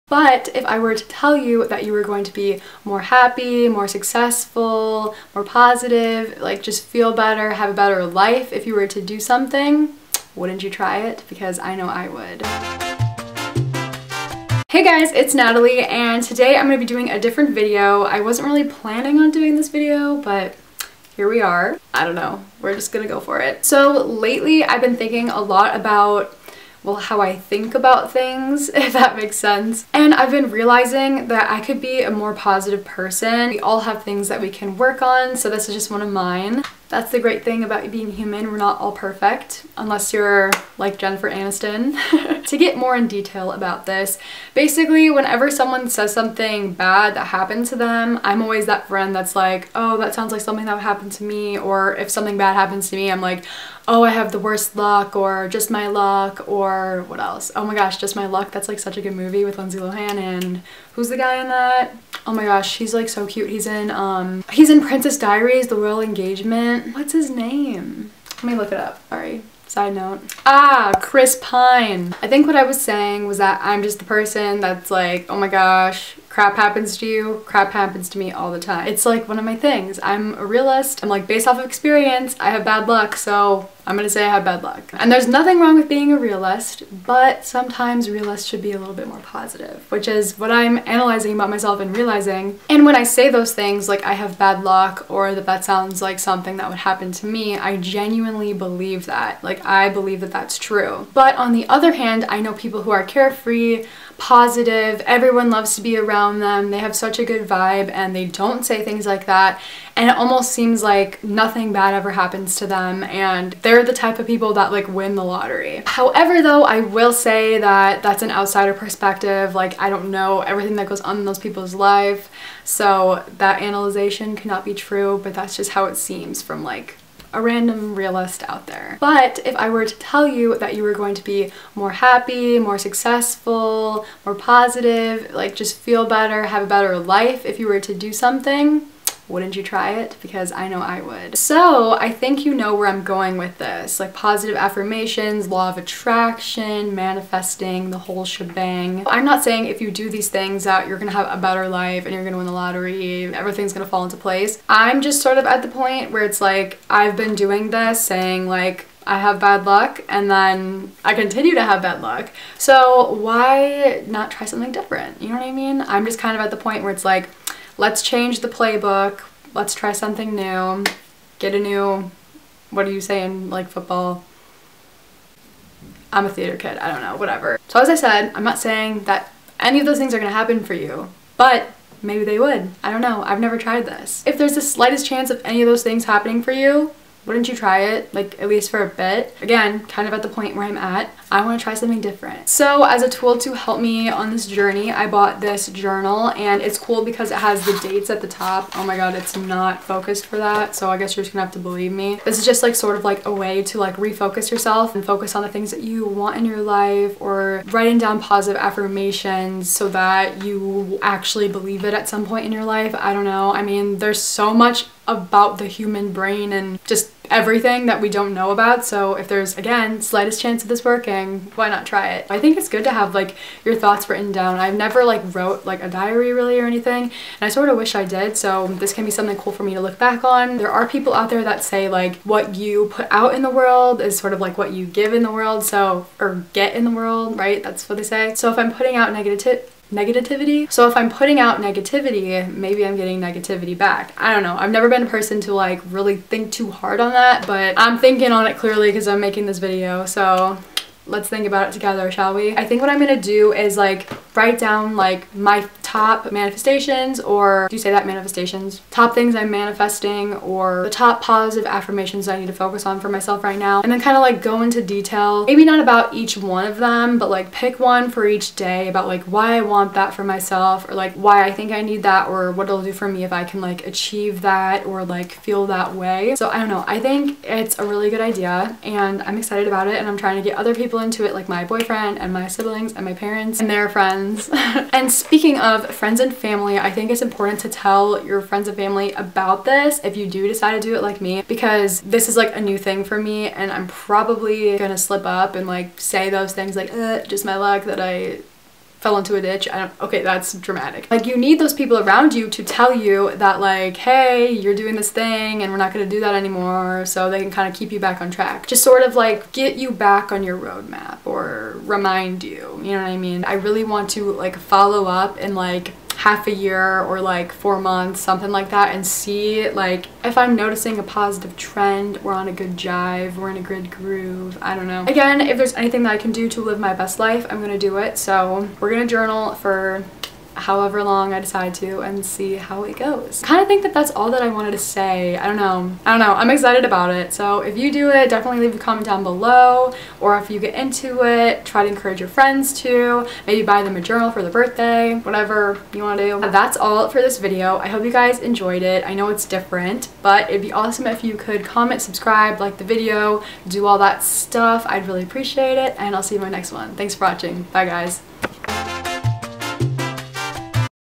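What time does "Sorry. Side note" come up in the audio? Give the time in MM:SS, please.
01:09.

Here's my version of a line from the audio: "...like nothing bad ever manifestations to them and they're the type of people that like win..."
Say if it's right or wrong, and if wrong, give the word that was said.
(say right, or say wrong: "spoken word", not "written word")
wrong: "happens", not "manifestations".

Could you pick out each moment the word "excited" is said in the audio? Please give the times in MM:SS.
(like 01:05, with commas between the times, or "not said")
04:39, 05:36.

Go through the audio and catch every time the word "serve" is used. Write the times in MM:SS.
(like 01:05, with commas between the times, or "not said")
not said.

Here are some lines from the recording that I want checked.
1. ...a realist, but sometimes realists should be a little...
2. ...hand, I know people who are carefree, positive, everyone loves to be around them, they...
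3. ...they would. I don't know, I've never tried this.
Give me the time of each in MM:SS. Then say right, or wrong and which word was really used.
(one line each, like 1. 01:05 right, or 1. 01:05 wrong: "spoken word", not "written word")
1. 01:26 right
2. 01:41 right
3. 03:02 right.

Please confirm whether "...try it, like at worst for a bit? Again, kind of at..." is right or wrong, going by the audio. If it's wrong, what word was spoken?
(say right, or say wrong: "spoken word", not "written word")
wrong: "least", not "worst".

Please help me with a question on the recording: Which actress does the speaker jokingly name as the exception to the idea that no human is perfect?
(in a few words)
Jennifer Aniston.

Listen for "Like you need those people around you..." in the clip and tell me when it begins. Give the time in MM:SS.
05:01.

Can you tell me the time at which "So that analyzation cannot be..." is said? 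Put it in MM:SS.
02:02.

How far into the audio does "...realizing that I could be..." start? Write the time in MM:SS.
00:30.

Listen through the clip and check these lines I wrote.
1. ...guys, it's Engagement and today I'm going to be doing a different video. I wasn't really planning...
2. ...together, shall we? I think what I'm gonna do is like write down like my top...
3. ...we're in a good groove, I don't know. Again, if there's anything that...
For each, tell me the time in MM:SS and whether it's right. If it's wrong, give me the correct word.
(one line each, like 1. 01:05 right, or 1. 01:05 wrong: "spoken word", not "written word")
1. 00:14 wrong: "Natalie", not "Engagement"
2. 04:11 right
3. 05:23 right.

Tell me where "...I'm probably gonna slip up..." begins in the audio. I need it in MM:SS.
04:53.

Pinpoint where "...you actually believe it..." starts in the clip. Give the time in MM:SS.
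03:30.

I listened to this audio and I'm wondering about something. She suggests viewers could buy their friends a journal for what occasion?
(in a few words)
birthday.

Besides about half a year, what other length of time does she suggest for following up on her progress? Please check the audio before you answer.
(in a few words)
4 months.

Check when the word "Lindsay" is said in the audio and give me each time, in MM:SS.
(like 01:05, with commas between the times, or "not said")
00:59.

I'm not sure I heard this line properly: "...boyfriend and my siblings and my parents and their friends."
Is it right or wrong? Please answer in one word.
right.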